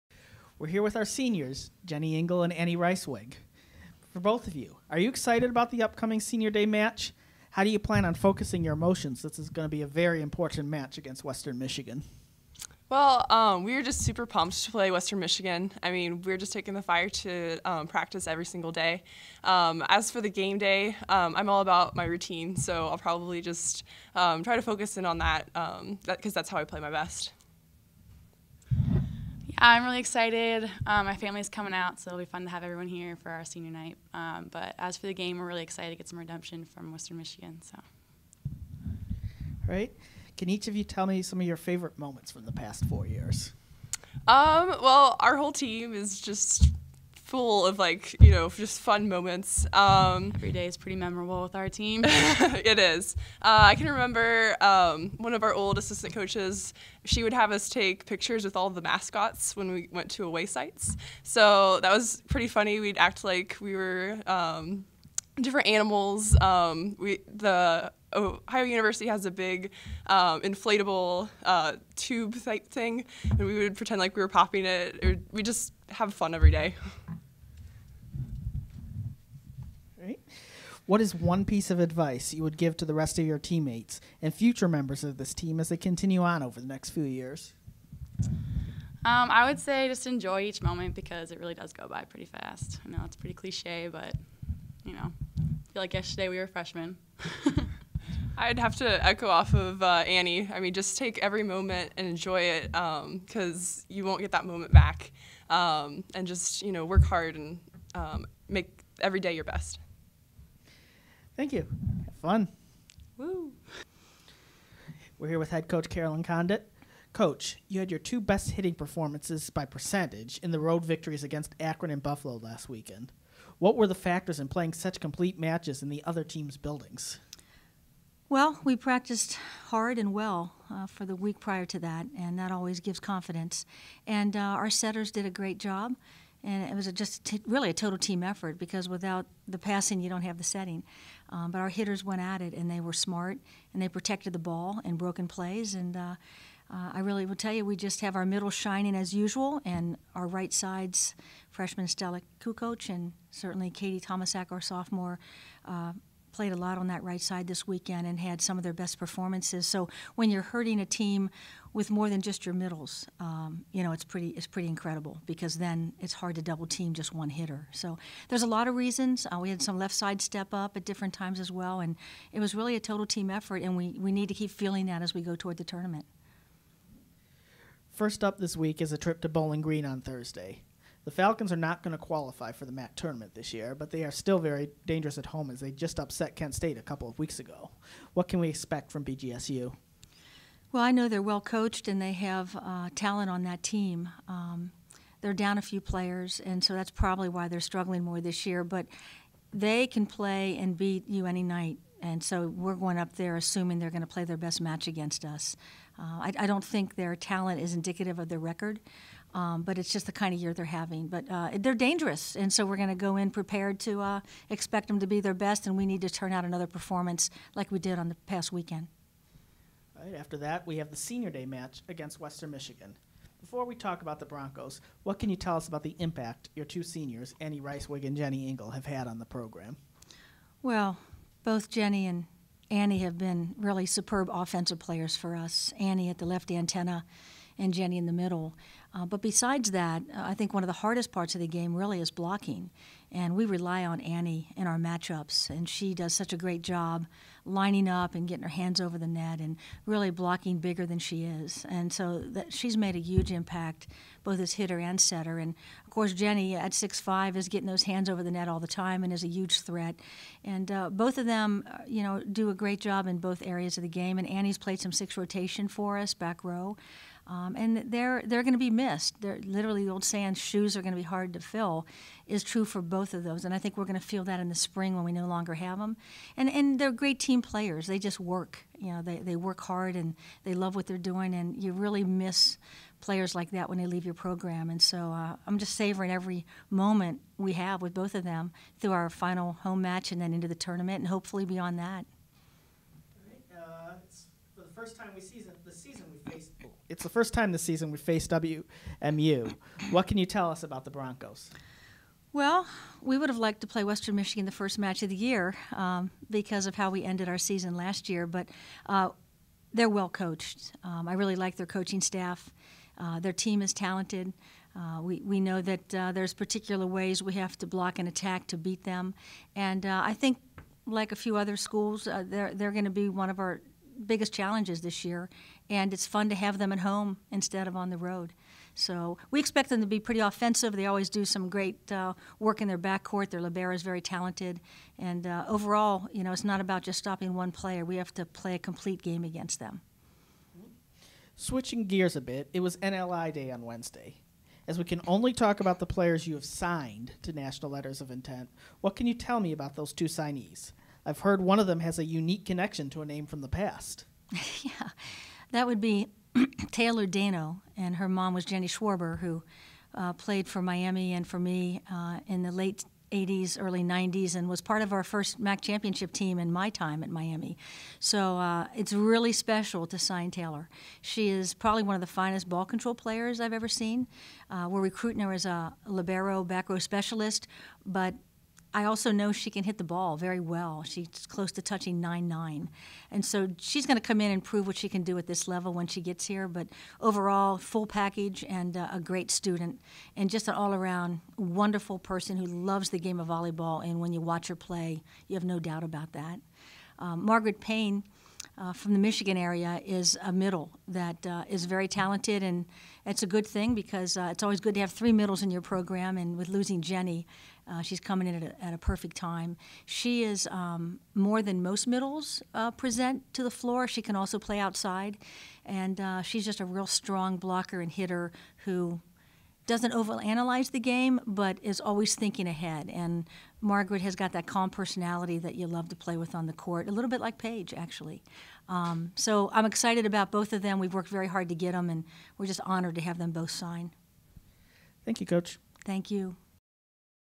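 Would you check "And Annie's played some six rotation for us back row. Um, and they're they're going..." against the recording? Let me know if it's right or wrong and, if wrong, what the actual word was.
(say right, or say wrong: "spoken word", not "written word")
right.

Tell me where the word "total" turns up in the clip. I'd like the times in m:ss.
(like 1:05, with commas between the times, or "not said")
2:17, 2:52.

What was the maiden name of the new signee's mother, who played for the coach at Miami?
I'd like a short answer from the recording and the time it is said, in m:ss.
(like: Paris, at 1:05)
Jenny Schwarber, at 5:58.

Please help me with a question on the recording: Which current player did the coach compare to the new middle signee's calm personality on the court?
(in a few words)
Paige.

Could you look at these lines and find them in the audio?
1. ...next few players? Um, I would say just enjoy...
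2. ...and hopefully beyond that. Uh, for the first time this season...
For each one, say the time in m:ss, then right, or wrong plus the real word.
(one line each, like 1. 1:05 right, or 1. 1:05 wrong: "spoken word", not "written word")
1. 1:26 wrong: "years", not "players"
2. 4:50 right.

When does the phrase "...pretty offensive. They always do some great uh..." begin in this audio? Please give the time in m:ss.
5:29.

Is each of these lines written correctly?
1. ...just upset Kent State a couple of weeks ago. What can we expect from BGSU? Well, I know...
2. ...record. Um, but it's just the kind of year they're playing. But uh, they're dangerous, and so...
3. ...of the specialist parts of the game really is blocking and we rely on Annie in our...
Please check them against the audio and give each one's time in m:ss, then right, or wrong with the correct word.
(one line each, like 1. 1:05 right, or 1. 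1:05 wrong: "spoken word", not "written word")
1. 3:05 right
2. 3:28 wrong: "having", not "playing"
3. 4:00 wrong: "hardest", not "specialist".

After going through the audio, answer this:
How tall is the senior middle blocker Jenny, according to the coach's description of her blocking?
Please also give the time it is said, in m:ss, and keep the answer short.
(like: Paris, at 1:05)
6'5", at 4:16.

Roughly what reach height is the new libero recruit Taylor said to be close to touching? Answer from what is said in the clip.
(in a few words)
9'9".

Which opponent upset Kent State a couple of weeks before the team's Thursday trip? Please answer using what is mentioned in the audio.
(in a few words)
Bowling Green.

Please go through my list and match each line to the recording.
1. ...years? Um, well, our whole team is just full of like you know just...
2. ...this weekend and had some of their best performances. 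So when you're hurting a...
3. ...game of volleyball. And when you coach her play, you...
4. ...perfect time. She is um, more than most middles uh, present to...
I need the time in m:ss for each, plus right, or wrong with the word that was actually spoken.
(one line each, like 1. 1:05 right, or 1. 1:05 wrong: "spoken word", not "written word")
1. 0:43 right
2. 2:37 right
3. 6:32 wrong: "watch", not "coach"
4. 6:48 right.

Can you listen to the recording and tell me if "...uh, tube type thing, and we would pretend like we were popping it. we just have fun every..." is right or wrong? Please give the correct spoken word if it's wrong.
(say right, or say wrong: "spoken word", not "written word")
right.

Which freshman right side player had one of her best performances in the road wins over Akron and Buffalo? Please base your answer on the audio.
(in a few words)
Stella Kukoc.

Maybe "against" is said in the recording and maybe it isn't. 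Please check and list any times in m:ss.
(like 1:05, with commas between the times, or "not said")
0:10, 2:01, 3:24, 3:41, 5:39.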